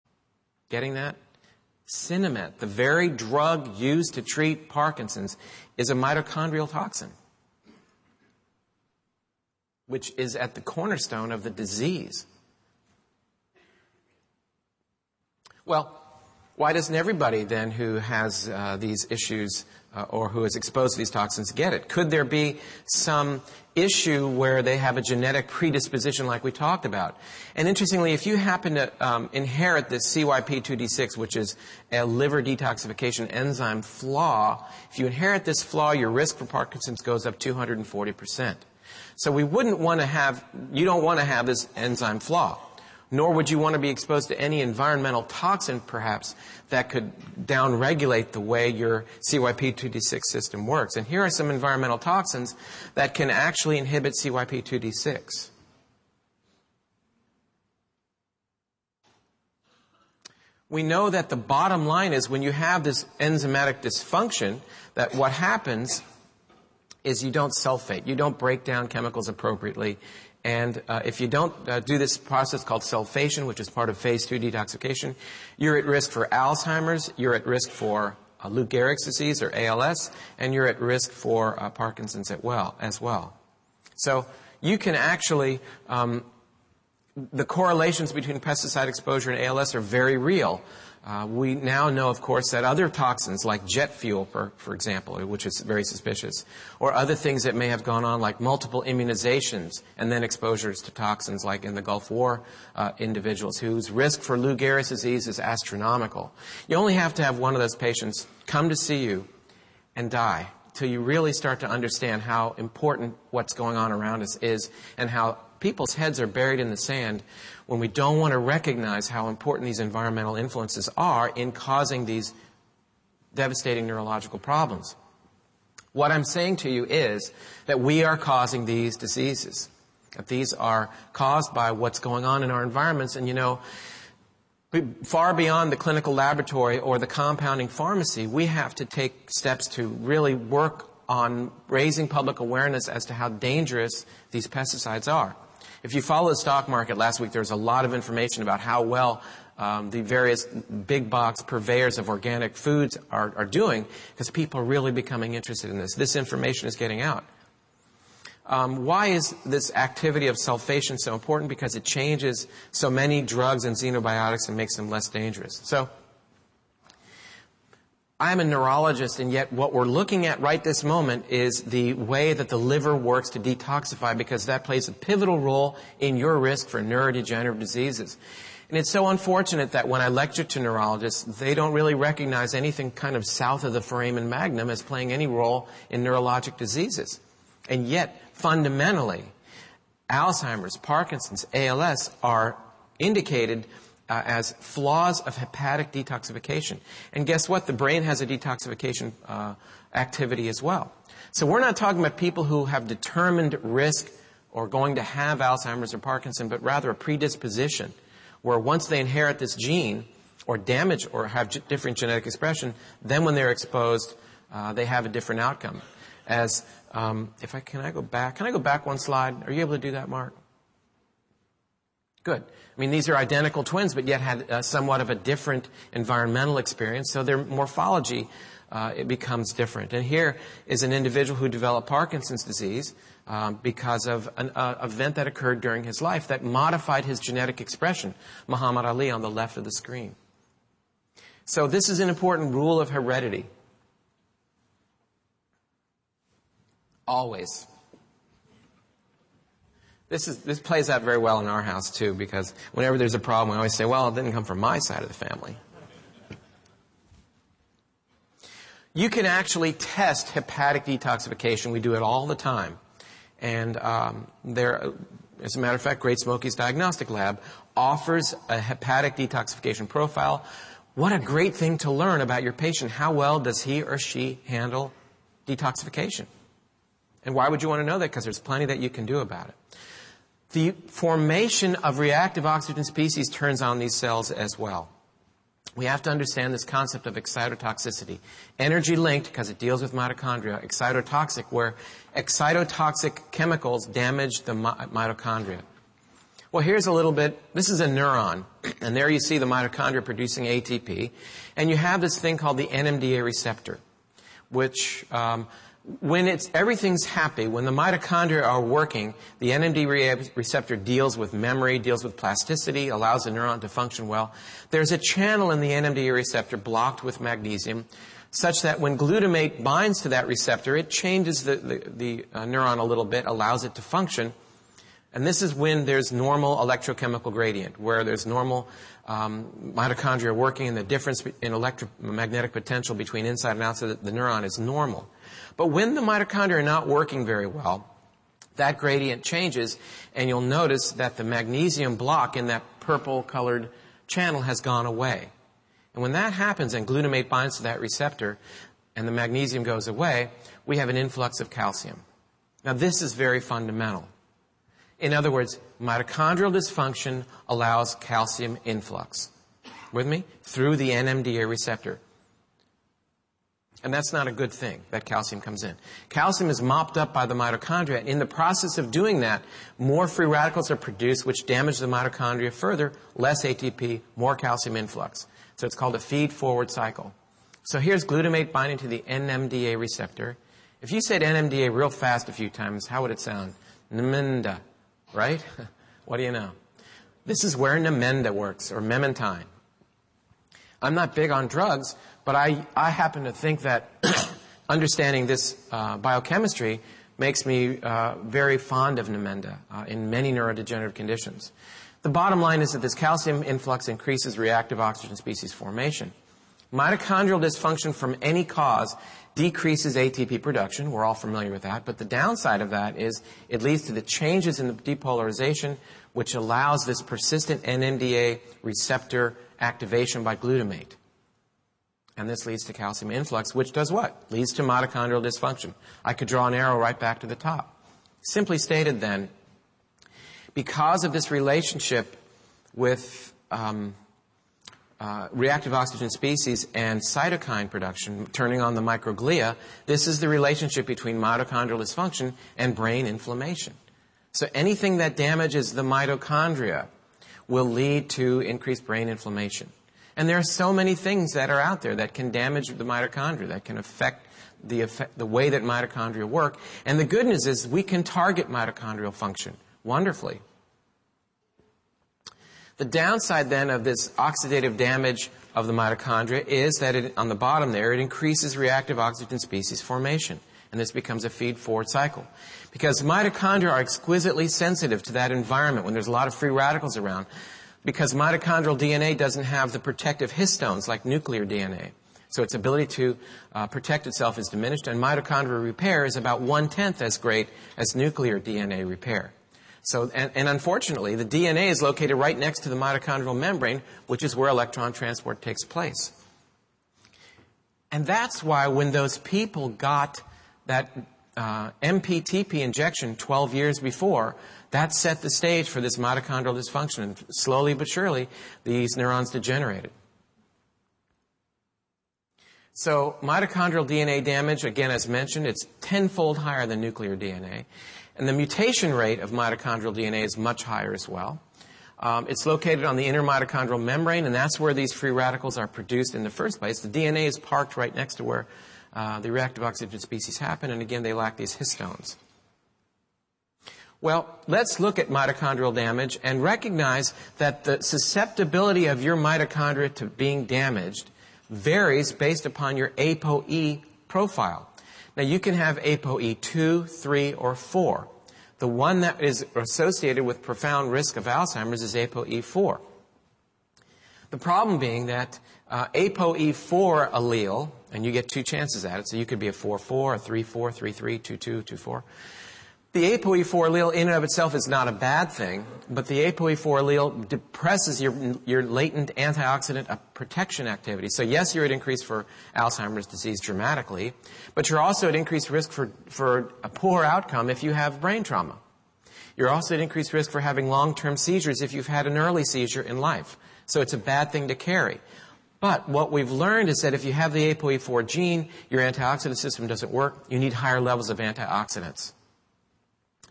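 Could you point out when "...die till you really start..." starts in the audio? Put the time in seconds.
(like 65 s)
110 s.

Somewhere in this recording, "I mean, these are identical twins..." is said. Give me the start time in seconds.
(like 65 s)
222 s.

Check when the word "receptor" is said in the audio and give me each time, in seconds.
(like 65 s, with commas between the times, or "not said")
303 s, 310 s, 316 s, 320 s, 347 s, 361 s, 379 s, 418 s.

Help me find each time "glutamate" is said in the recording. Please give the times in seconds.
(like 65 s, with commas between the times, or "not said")
318 s, 346 s, 378 s, 420 s.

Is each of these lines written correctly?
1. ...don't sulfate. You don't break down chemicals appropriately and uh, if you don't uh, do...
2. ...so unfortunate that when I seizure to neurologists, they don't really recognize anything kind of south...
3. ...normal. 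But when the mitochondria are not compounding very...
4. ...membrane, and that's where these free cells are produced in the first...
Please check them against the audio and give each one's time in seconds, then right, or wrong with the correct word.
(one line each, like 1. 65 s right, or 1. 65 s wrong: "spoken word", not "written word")
1. 67 s right
2. 178 s wrong: "lecture", not "seizure"
3. 334 s wrong: "working", not "compounding"
4. 523 s wrong: "radicals", not "cells".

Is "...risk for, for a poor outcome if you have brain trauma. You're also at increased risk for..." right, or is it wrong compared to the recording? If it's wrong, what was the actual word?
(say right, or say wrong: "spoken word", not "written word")
right.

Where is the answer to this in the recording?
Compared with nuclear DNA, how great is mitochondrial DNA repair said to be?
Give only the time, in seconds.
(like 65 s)
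486 s.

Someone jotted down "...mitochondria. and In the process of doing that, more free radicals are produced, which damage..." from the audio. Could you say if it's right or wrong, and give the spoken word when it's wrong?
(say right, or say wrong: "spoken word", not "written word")
right.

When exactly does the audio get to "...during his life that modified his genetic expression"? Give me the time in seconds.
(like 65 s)
235 s.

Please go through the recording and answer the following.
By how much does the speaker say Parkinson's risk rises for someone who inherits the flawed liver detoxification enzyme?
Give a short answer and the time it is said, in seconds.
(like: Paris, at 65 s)
240%, at 37 s.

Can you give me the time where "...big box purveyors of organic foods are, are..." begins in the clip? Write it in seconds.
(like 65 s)
150 s.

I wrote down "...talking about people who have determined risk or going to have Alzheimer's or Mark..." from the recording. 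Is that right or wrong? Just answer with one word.
wrong.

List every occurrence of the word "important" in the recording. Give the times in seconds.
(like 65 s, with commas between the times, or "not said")
112 s, 119 s, 161 s, 242 s.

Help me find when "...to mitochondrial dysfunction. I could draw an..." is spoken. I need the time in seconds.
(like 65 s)
424 s.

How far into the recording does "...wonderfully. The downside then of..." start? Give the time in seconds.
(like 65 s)
459 s.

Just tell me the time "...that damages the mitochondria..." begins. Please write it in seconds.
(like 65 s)
444 s.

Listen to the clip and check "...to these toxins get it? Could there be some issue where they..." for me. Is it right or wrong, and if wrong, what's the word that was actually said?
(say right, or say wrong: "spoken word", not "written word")
right.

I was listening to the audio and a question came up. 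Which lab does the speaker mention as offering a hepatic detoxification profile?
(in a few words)
Great Smokies Diagnostic Lab.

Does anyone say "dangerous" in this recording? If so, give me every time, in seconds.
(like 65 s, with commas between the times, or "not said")
143 s, 165 s.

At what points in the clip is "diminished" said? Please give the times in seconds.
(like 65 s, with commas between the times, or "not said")
484 s.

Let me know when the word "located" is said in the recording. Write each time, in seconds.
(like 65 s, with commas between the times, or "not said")
491 s, 522 s.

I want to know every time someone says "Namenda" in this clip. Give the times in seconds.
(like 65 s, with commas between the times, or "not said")
387 s, 399 s.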